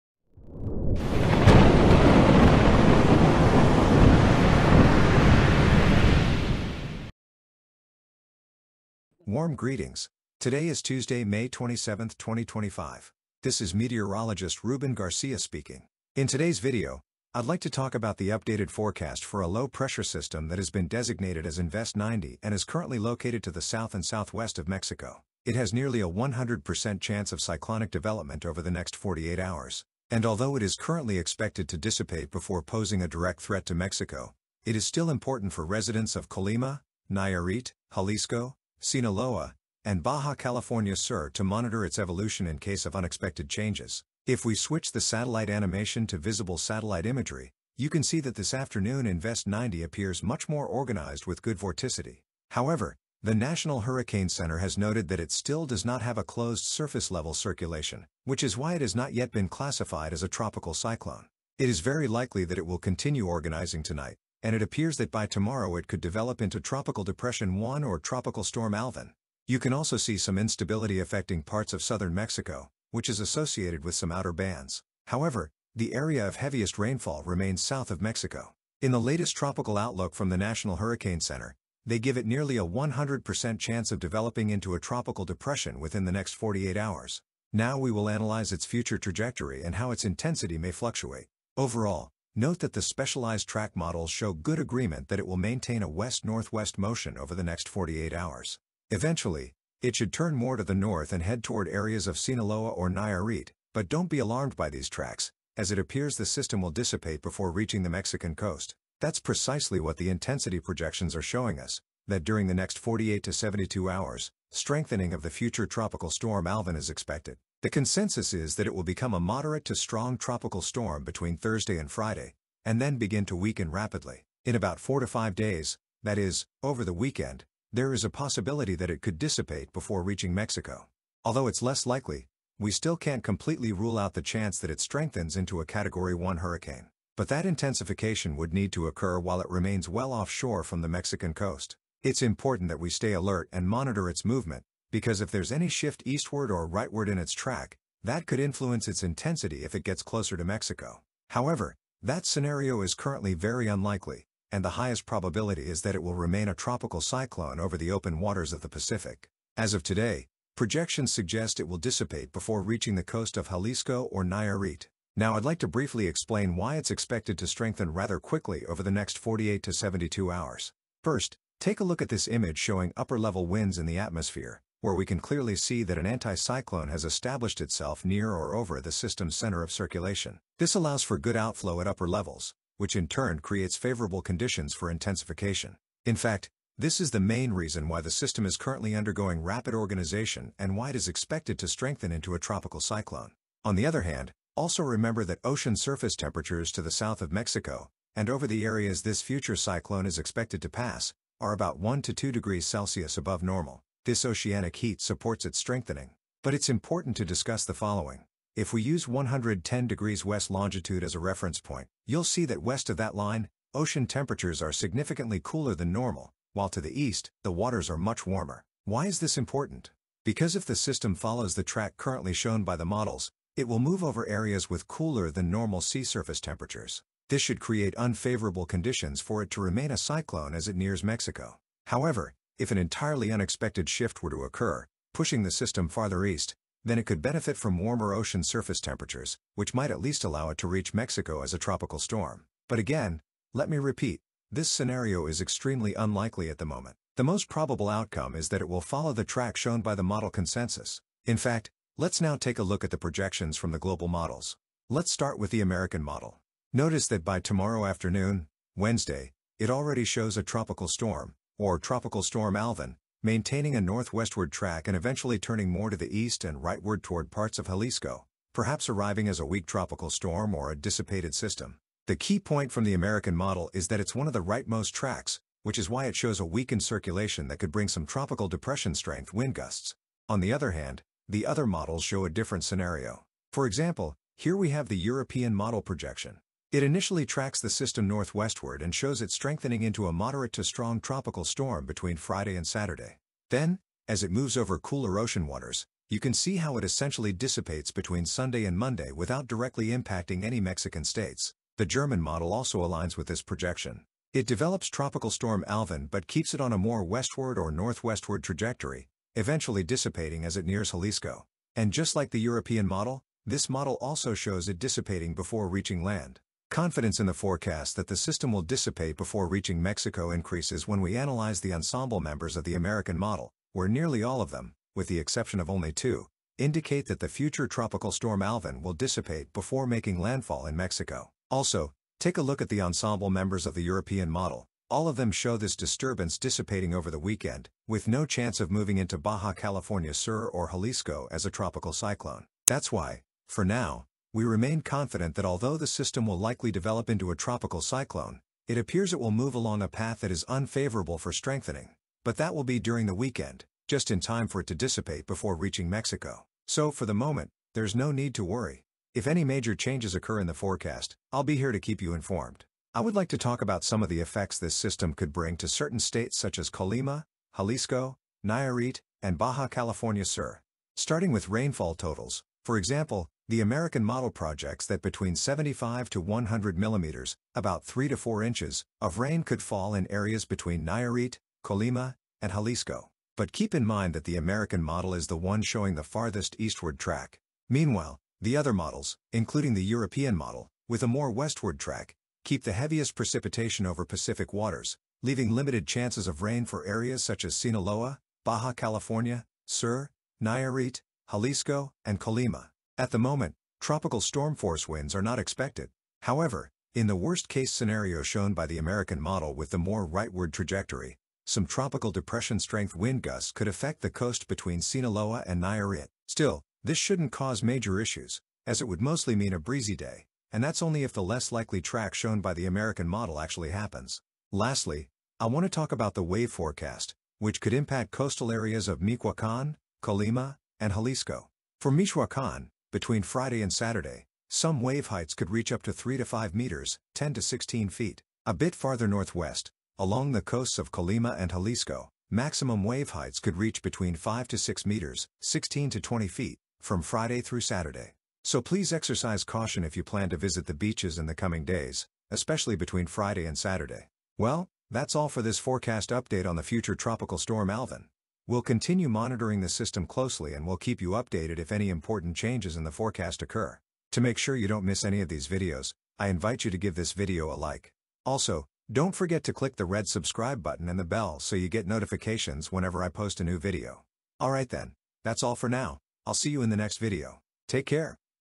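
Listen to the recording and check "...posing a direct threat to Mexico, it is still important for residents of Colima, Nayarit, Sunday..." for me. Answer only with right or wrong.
wrong.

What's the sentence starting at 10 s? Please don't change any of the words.
Today is Tuesday, May 27, 2025.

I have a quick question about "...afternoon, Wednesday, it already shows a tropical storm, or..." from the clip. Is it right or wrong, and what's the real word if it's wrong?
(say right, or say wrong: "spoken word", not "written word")
right.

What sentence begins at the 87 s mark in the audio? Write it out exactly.
Now we will analyze its future trajectory and how its intensity may fluctuate.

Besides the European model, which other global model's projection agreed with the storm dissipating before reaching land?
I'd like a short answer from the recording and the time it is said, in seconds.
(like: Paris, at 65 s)
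German model, at 301 s.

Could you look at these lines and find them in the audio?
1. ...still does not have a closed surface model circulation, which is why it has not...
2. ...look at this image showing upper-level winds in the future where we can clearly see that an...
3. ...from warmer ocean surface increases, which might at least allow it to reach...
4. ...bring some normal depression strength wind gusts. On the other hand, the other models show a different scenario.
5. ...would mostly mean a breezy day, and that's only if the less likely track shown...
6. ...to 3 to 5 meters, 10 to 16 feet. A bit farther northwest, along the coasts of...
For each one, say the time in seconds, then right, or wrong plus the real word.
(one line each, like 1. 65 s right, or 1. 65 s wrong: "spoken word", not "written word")
1. 55 s wrong: "level", not "model"
2. 171 s wrong: "atmosphere", not "future"
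3. 237 s wrong: "temperatures", not "increases"
4. 277 s wrong: "tropical", not "normal"
5. 418 s right
6. 435 s right.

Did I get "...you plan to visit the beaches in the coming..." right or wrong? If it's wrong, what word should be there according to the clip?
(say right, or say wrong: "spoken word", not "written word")
right.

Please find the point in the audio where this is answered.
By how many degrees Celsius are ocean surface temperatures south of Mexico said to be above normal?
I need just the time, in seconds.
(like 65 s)
201 s.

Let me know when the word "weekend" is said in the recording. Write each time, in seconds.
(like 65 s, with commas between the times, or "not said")
126 s, 337 s, 353 s.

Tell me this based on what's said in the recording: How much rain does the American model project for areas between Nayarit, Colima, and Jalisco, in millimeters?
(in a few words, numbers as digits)
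75 to 100 millimeters.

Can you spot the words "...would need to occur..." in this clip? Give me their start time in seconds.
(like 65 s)
138 s.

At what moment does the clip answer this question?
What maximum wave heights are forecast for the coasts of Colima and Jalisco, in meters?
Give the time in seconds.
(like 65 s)
444 s.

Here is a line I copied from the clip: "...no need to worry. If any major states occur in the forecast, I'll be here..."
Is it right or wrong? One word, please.
wrong.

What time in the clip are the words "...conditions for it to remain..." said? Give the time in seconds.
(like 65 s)
228 s.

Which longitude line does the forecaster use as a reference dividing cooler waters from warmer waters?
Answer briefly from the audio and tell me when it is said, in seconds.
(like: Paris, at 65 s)
110 degrees west, at 209 s.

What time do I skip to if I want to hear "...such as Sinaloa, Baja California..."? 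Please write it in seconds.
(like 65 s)
397 s.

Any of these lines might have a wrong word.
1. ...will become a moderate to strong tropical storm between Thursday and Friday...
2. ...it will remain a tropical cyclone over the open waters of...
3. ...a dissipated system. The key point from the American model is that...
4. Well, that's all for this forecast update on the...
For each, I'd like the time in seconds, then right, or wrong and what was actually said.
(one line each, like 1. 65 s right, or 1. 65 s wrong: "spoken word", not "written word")
1. 118 s right
2. 155 s right
3. 270 s right
4. 454 s right.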